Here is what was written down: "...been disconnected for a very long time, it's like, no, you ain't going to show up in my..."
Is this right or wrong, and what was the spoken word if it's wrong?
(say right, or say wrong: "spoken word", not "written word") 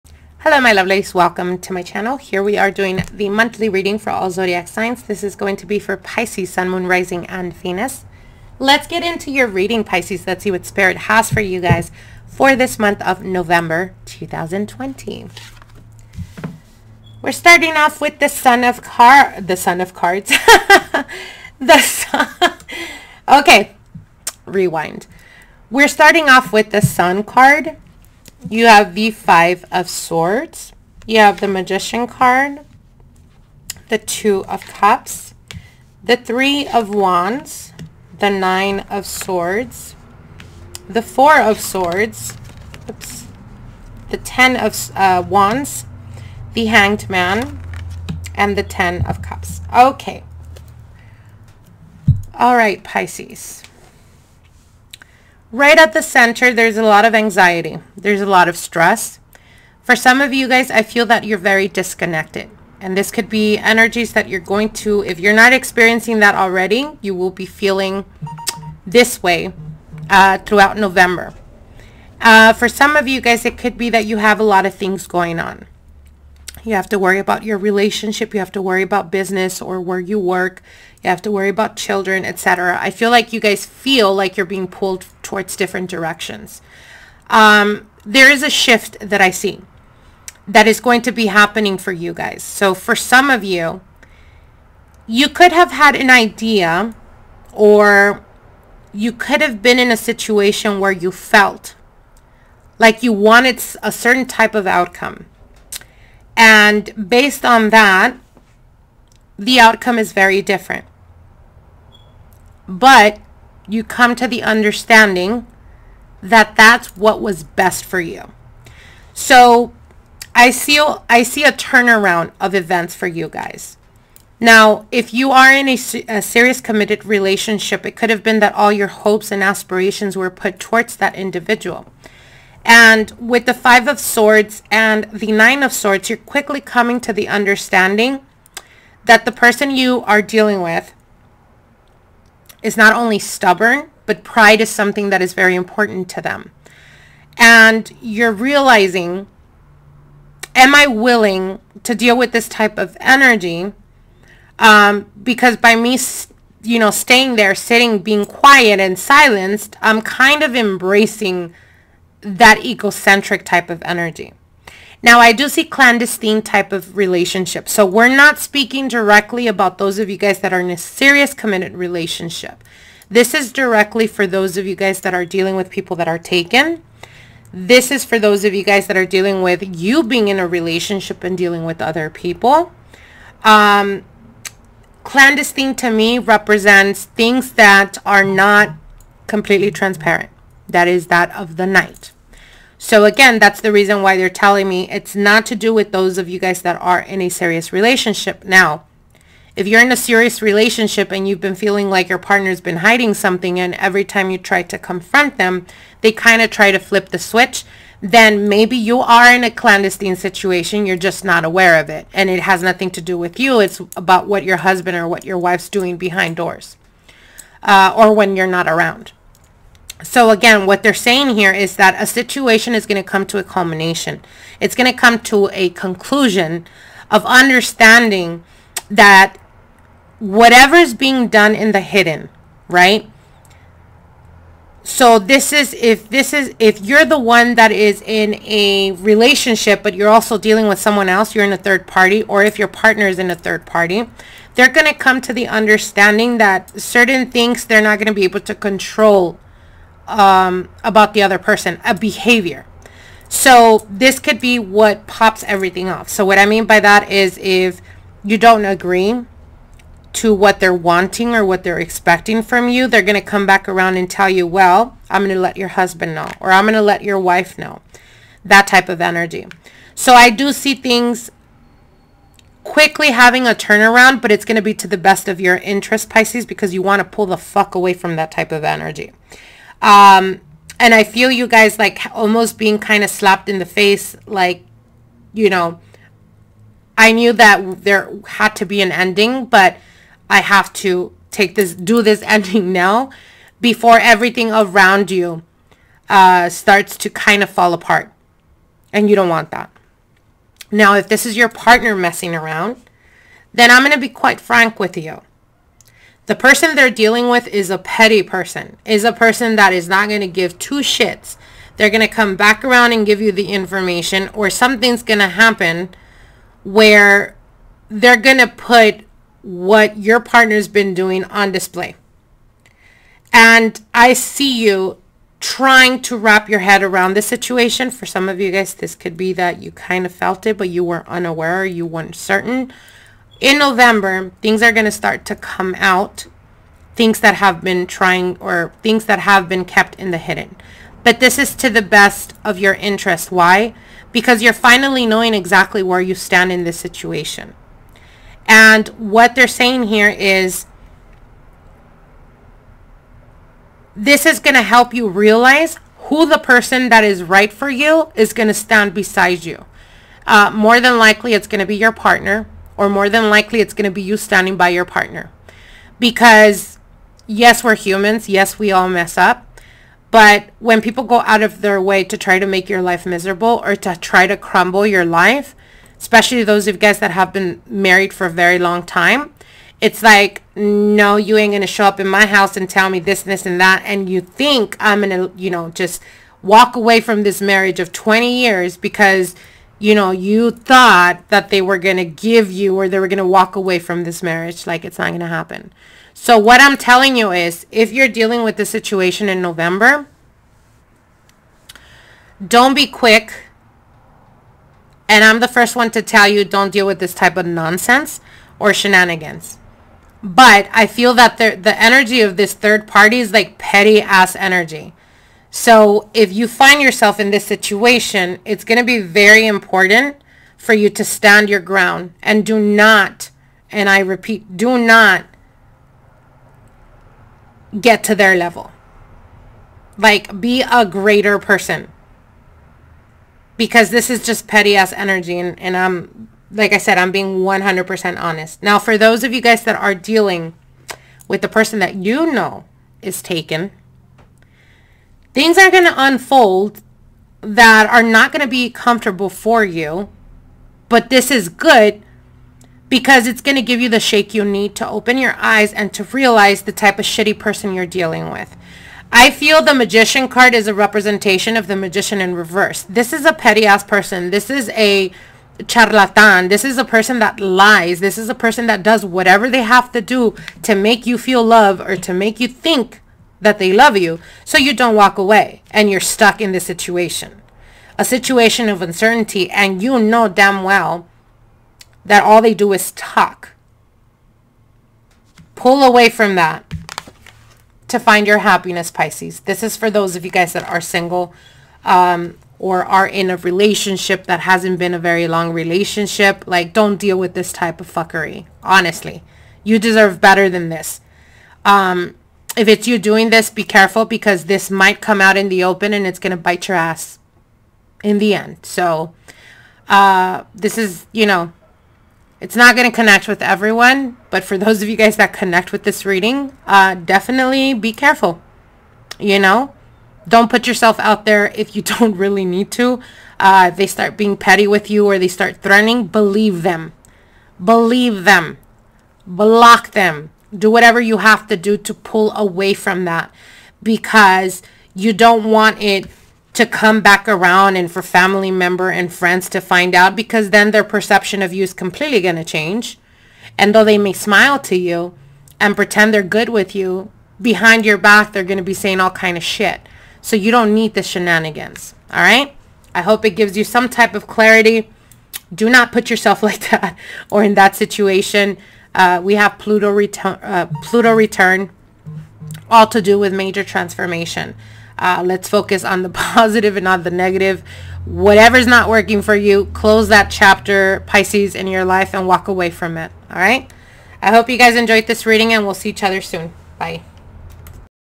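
wrong: "married", not "disconnected".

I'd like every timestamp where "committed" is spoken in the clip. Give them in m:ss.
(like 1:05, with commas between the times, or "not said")
2:06, 2:51.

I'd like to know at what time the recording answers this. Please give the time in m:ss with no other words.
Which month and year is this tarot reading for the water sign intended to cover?
0:13.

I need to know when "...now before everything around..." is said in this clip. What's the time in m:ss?
4:52.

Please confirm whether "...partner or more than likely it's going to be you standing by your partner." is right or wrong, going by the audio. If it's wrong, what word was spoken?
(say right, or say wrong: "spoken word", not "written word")
right.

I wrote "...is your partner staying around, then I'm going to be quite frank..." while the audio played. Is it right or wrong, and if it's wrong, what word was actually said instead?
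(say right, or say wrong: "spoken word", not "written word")
wrong: "messing", not "staying".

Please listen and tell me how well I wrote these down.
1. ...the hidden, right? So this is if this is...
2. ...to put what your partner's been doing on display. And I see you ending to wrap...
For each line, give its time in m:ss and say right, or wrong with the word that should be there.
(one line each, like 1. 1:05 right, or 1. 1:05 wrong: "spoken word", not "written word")
1. 3:51 right
2. 5:18 wrong: "trying", not "ending".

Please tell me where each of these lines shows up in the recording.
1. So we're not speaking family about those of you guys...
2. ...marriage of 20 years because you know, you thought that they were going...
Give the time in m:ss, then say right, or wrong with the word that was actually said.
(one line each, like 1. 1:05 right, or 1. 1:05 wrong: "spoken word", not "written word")
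1. 2:47 wrong: "directly", not "family"
2. 6:27 right.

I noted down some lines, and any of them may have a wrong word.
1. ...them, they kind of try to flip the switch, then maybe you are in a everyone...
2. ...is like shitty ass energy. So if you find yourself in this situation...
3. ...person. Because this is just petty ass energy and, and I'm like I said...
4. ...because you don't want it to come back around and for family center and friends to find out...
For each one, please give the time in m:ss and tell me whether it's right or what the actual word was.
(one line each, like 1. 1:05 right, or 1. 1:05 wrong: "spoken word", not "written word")
1. 3:25 wrong: "clandestine", not "everyone"
2. 6:53 wrong: "petty", not "shitty"
3. 7:11 right
4. 8:53 wrong: "member", not "center".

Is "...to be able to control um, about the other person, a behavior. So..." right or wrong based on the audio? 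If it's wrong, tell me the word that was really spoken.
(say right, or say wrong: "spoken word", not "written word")
right.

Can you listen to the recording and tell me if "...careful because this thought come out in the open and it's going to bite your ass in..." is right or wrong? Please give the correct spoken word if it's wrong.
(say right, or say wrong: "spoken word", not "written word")
wrong: "might", not "thought".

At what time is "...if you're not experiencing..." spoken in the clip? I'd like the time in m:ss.
1:05.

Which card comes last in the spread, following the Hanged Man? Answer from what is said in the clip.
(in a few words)
Ten of Cups.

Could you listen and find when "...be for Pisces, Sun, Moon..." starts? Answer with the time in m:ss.
0:05.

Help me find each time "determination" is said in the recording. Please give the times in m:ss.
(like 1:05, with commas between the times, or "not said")
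not said.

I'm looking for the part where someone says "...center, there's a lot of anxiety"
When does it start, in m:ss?
0:56.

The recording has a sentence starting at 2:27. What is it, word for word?
And you're realizing, am I willing to deal with this type of energy?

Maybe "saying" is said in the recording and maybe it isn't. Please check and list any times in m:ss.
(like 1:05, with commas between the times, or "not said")
3:40, 5:49, 9:08.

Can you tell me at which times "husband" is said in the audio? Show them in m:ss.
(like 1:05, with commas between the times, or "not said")
3:34, 4:25.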